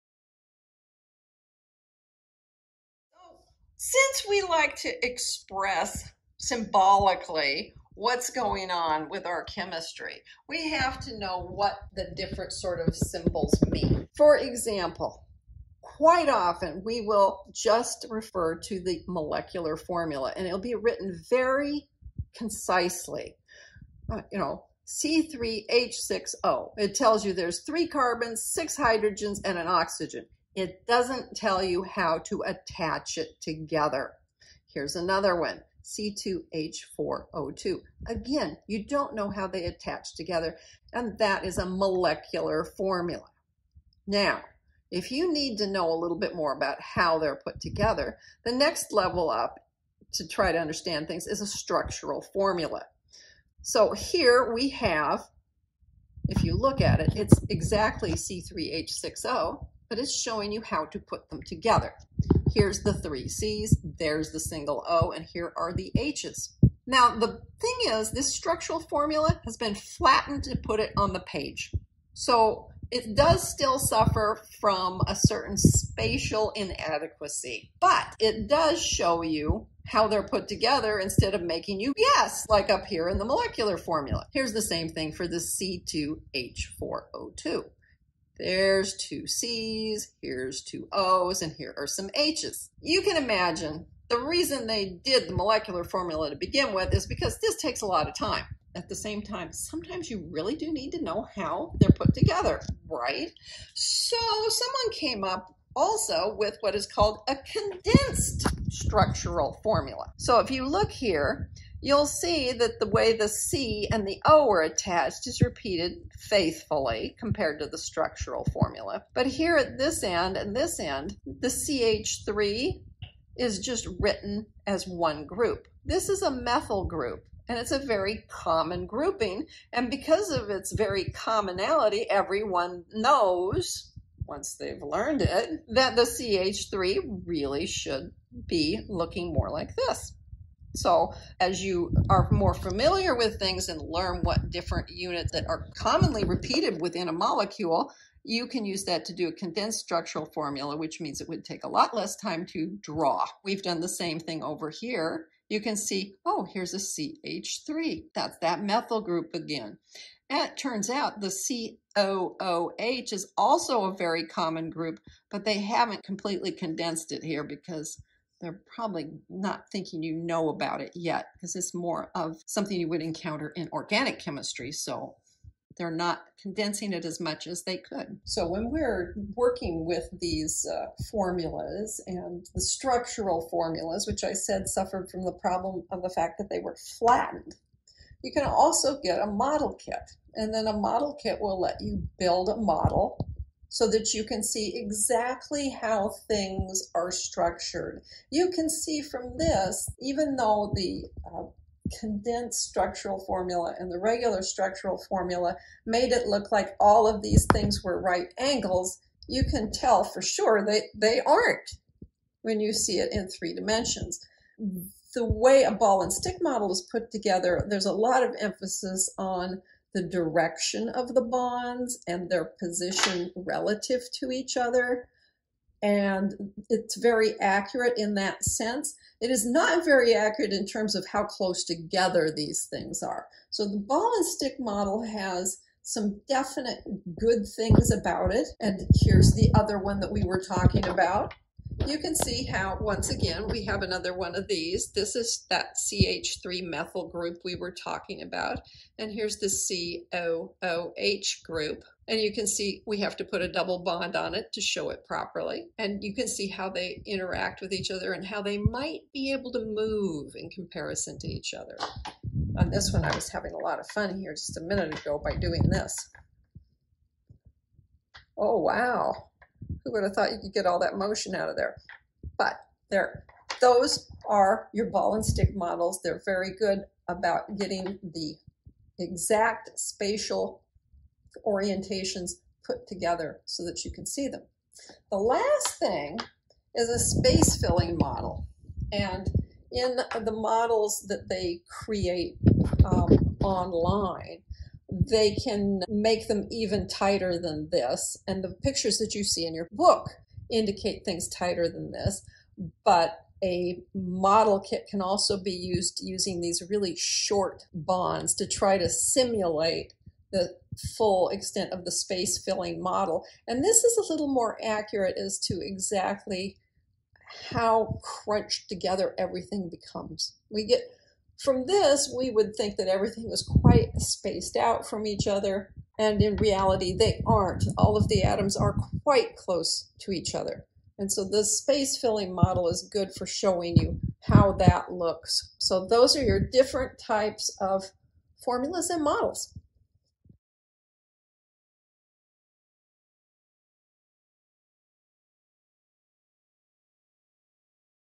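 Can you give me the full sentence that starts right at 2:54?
So they're not condensing it as much as they could.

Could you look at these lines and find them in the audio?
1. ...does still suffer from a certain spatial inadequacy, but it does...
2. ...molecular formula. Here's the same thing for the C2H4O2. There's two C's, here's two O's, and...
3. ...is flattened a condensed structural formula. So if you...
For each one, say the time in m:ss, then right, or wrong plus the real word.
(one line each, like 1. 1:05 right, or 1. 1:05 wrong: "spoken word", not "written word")
1. 1:13 right
2. 1:23 right
3. 1:46 wrong: "called", not "flattened".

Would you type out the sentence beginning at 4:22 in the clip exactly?
On this one, I was having a lot of fun here just a minute ago by doing this.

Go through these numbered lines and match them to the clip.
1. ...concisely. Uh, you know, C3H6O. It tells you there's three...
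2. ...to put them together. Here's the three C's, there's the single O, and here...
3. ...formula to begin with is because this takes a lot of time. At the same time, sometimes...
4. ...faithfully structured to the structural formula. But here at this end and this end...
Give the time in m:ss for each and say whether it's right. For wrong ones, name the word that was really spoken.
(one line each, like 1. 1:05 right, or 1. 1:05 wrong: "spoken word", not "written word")
1. 0:22 right
2. 1:00 right
3. 1:35 right
4. 1:56 wrong: "compared", not "structured".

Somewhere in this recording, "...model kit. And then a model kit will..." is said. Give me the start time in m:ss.
3:09.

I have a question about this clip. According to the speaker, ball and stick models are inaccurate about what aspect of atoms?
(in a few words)
how close together.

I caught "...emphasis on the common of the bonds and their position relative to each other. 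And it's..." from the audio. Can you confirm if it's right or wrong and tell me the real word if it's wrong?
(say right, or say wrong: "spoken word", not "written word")
wrong: "direction", not "common".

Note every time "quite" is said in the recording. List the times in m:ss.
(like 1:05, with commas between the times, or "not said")
0:15, 5:23, 5:29.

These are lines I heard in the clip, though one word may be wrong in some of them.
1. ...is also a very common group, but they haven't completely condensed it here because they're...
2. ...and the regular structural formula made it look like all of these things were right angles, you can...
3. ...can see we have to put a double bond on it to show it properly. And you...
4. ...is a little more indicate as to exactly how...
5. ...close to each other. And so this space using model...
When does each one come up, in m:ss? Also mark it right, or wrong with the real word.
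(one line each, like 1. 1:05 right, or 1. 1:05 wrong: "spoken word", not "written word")
1. 2:43 right
2. 3:23 right
3. 4:12 right
4. 5:13 wrong: "accurate", not "indicate"
5. 5:29 wrong: "filling", not "using".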